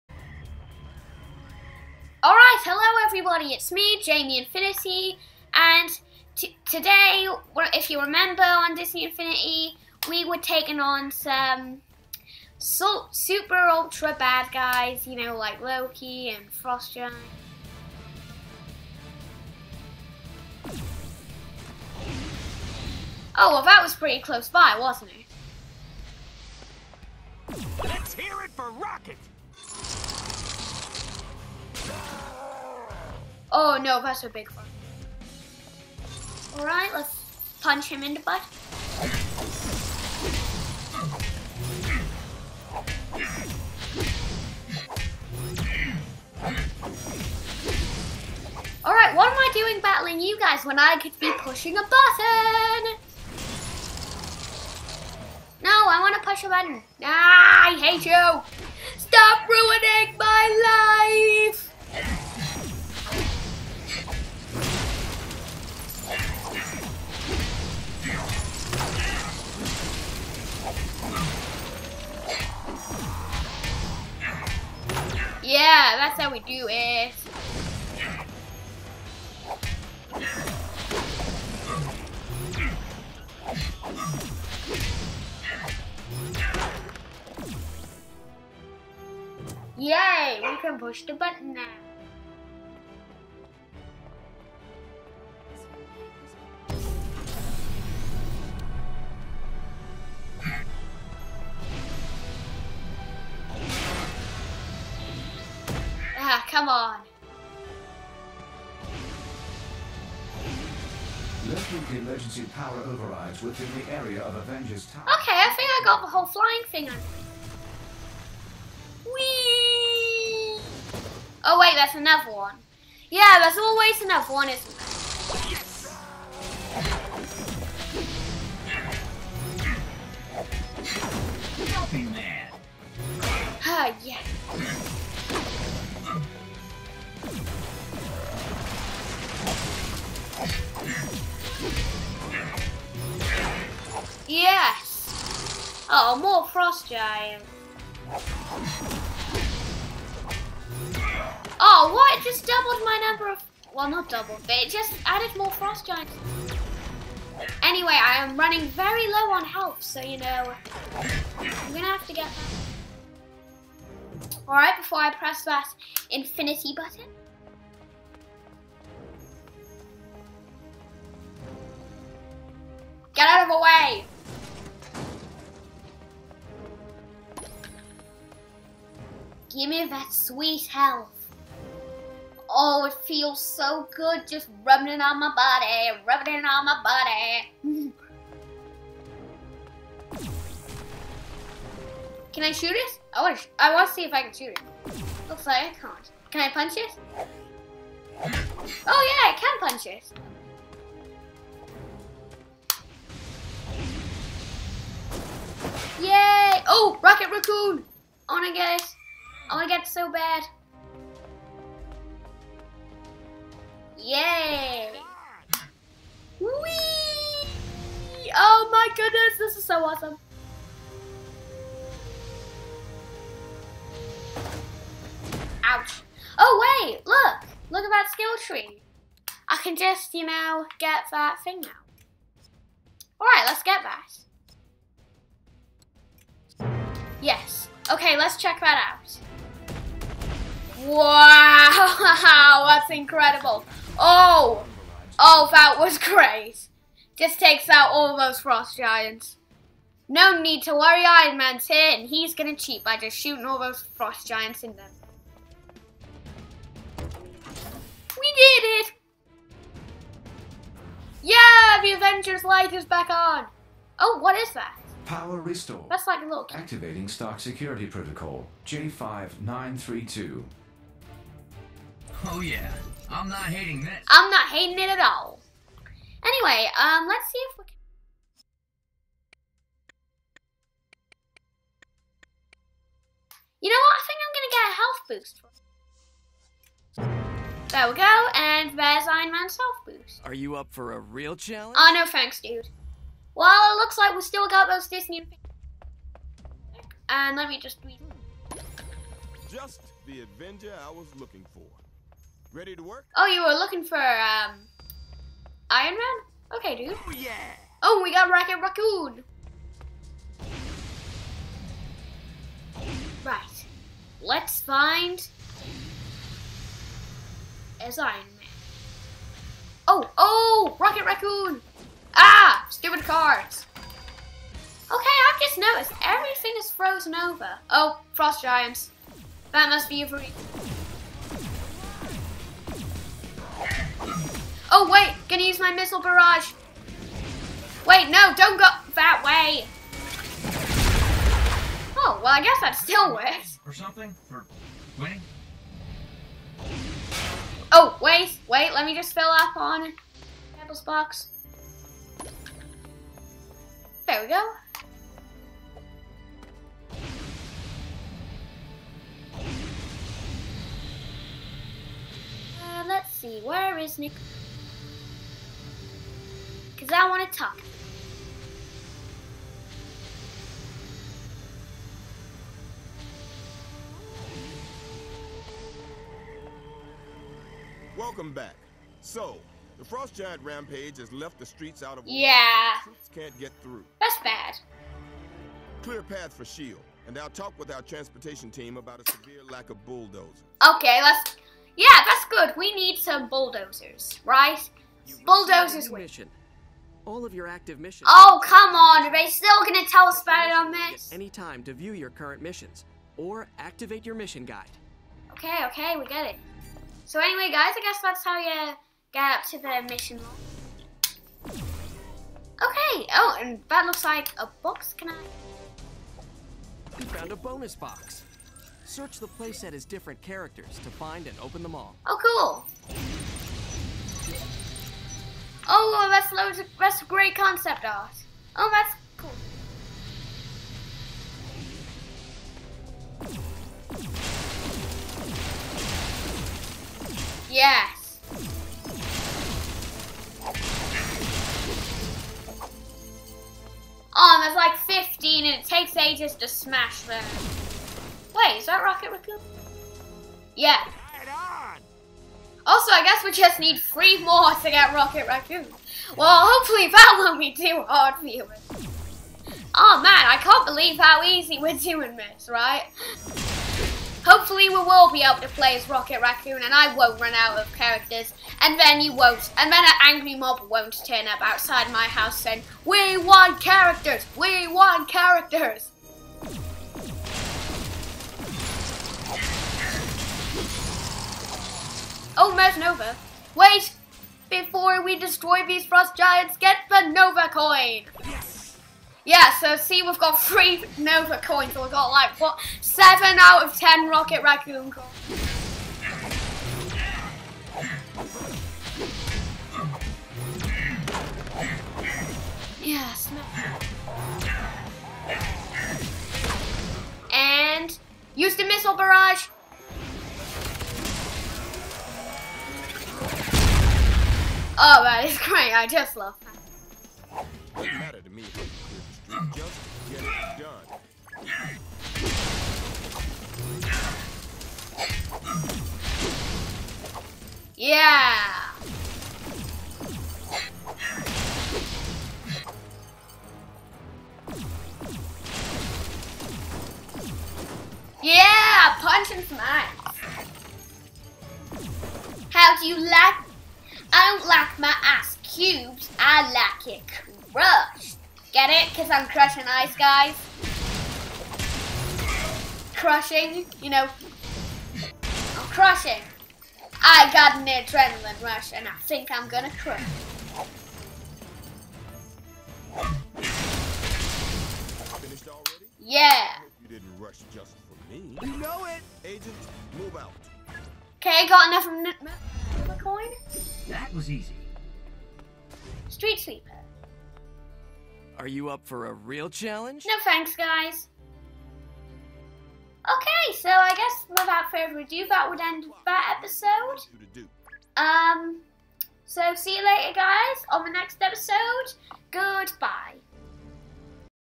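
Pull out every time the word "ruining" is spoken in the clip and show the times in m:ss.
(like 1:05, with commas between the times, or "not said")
0:59.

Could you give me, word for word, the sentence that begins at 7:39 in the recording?
Oh man, I can't believe how easy we're doing this, right?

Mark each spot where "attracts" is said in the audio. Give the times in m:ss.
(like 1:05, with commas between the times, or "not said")
not said.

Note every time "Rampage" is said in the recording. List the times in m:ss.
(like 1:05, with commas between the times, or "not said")
6:20.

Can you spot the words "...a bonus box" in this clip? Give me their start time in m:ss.
6:57.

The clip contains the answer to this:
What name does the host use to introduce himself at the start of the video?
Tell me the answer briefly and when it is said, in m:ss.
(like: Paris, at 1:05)
Jamie Infinity, at 0:04.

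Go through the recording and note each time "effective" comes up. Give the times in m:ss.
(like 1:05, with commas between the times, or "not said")
not said.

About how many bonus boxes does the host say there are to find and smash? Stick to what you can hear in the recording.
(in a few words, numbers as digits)
15.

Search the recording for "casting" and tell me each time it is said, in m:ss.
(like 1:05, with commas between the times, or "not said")
not said.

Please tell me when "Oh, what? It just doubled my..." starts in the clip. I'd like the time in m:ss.
2:31.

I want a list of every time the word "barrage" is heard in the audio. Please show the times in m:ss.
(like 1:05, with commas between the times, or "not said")
5:35, 8:28.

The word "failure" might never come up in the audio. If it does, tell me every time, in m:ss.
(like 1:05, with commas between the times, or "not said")
not said.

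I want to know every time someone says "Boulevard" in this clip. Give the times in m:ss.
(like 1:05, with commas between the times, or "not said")
not said.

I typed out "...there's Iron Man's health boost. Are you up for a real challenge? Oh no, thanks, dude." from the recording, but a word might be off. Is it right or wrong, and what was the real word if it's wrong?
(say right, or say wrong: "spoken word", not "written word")
right.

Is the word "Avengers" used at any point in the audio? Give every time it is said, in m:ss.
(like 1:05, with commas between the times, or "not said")
1:54, 4:21, 5:00.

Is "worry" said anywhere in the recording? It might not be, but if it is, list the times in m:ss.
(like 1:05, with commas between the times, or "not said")
4:10.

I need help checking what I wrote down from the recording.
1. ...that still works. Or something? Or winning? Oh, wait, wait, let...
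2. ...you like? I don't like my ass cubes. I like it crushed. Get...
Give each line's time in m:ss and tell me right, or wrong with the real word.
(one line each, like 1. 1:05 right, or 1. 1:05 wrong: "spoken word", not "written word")
1. 5:42 right
2. 9:02 right.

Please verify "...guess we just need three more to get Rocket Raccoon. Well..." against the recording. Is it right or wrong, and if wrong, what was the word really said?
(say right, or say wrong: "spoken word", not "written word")
right.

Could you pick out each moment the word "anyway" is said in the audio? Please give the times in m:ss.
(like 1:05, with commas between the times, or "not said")
2:37, 4:36, 6:47.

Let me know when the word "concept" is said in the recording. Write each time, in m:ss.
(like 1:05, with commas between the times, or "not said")
7:07.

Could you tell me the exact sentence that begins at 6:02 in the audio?
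Uh, let's see, where is Nick?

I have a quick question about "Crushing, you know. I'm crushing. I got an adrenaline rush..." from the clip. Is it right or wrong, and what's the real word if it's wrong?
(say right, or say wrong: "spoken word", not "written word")
right.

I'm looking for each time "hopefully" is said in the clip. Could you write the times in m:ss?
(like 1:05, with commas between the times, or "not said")
7:36, 7:44.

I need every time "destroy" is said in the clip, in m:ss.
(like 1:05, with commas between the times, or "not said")
8:05.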